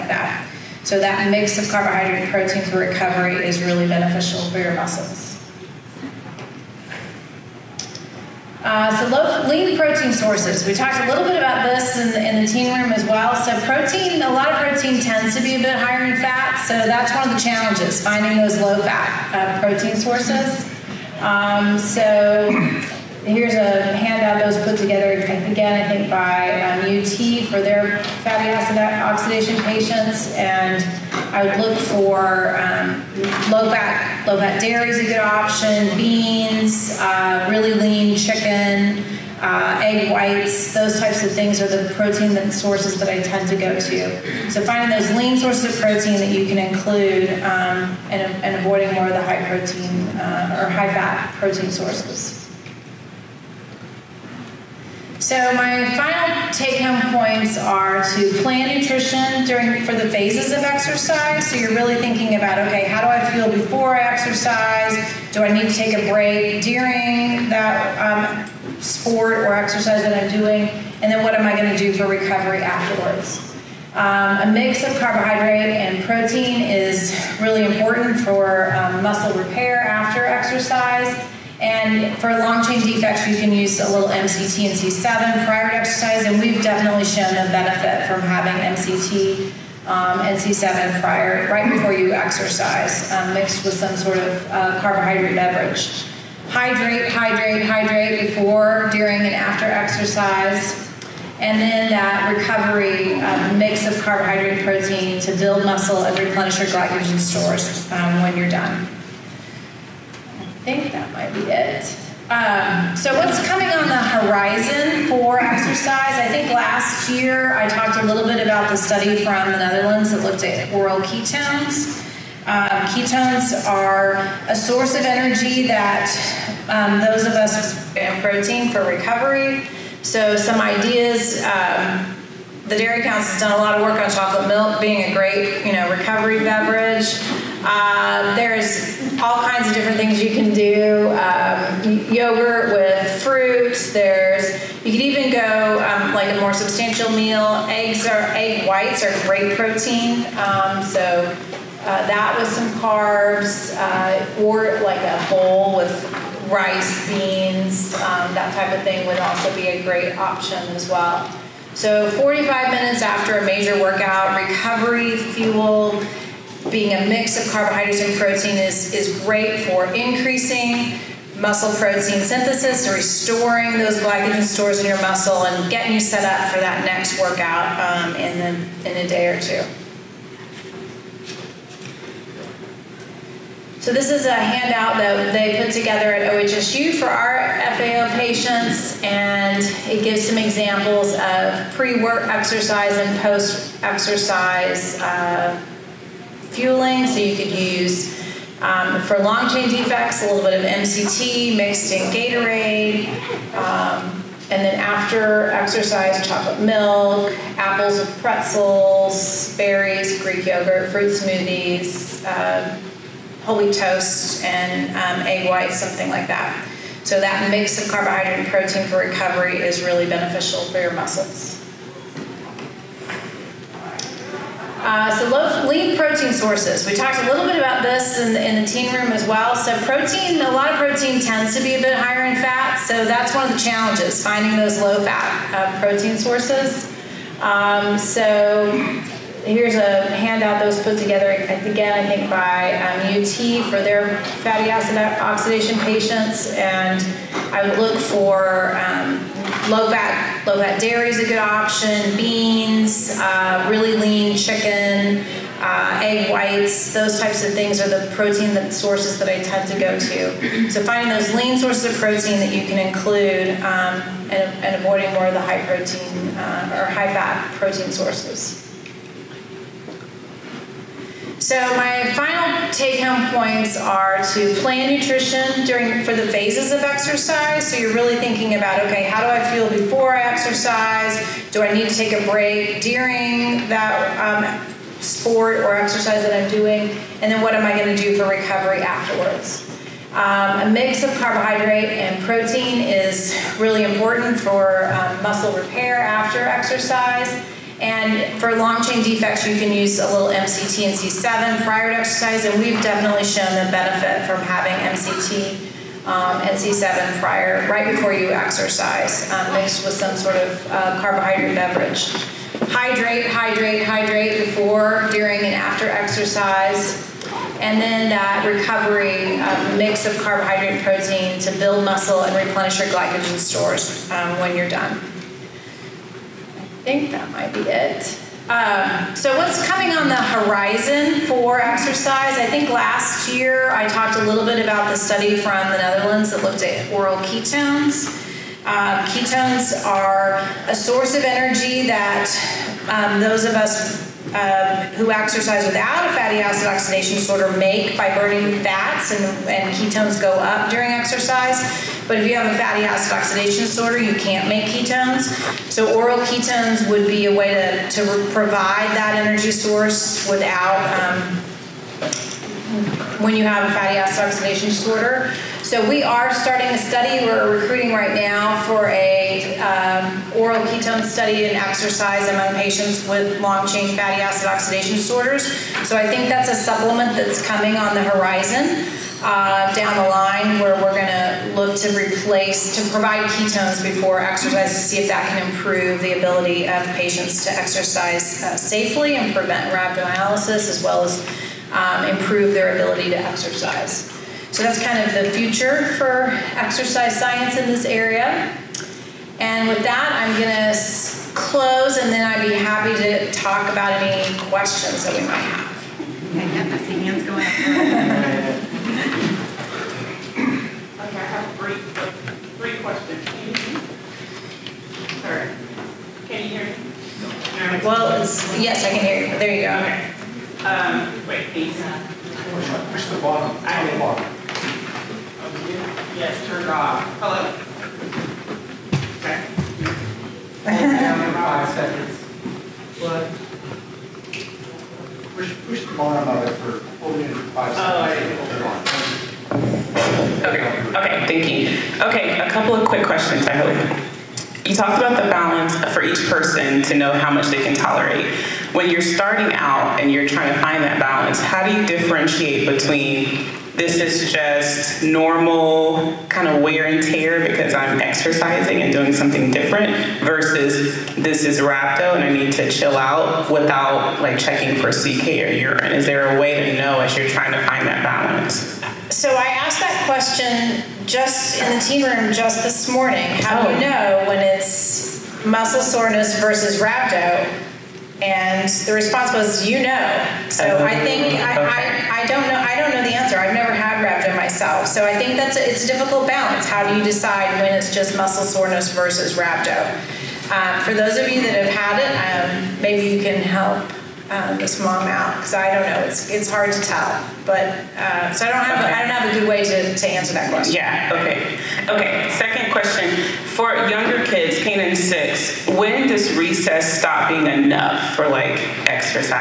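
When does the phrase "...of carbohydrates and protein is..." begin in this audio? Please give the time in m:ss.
2:47.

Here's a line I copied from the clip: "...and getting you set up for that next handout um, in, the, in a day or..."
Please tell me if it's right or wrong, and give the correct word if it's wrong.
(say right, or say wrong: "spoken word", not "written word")
wrong: "workout", not "handout".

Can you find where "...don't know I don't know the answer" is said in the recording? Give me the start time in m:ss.
8:02.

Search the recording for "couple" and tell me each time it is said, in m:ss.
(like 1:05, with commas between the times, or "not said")
7:22.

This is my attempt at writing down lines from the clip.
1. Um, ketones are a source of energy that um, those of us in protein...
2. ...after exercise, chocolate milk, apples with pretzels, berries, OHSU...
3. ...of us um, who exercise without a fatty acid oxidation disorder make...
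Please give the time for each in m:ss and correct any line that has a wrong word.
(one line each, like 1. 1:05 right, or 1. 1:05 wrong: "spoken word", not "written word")
1. 2:02 right
2. 3:24 wrong: "Greek", not "OHSU"
3. 5:43 right.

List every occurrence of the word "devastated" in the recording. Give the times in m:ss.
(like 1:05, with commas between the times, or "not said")
not said.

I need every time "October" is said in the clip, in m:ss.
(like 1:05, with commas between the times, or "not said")
not said.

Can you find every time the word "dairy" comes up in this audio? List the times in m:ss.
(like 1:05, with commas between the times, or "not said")
0:34, 2:12, 4:10.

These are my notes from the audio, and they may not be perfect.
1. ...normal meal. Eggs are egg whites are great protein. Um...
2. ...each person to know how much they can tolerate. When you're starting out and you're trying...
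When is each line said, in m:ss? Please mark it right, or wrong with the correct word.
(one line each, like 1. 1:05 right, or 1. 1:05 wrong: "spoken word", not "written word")
1. 2:26 wrong: "substantial", not "normal"
2. 7:26 right.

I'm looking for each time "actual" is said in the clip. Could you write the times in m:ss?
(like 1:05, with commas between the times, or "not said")
not said.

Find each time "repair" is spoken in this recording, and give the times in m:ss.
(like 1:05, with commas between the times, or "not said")
1:19, 4:55.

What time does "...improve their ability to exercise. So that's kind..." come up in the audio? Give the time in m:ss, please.
6:32.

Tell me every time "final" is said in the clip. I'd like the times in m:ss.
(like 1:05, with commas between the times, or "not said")
0:55, 4:32.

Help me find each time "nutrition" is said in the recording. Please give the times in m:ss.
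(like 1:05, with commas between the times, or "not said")
0:58, 4:34.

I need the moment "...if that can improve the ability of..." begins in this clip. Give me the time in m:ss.
6:24.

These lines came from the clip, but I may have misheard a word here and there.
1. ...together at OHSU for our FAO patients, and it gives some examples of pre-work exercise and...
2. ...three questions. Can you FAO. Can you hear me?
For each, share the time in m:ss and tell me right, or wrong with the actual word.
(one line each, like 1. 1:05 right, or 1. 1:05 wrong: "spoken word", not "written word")
1. 3:05 right
2. 6:52 wrong: "Sorry", not "FAO".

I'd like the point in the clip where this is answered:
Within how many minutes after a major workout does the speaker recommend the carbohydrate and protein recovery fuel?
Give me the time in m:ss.
2:42.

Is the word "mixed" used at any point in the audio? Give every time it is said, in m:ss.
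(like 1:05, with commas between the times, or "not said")
1:33, 3:21, 5:09.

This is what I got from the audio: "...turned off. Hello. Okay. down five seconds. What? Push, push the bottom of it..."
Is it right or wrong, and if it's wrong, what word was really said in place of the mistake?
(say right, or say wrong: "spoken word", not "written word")
right.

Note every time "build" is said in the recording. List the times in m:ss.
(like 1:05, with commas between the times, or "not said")
1:45, 5:21.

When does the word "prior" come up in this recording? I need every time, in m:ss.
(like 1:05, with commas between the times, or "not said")
1:25, 1:31, 5:01, 5:07.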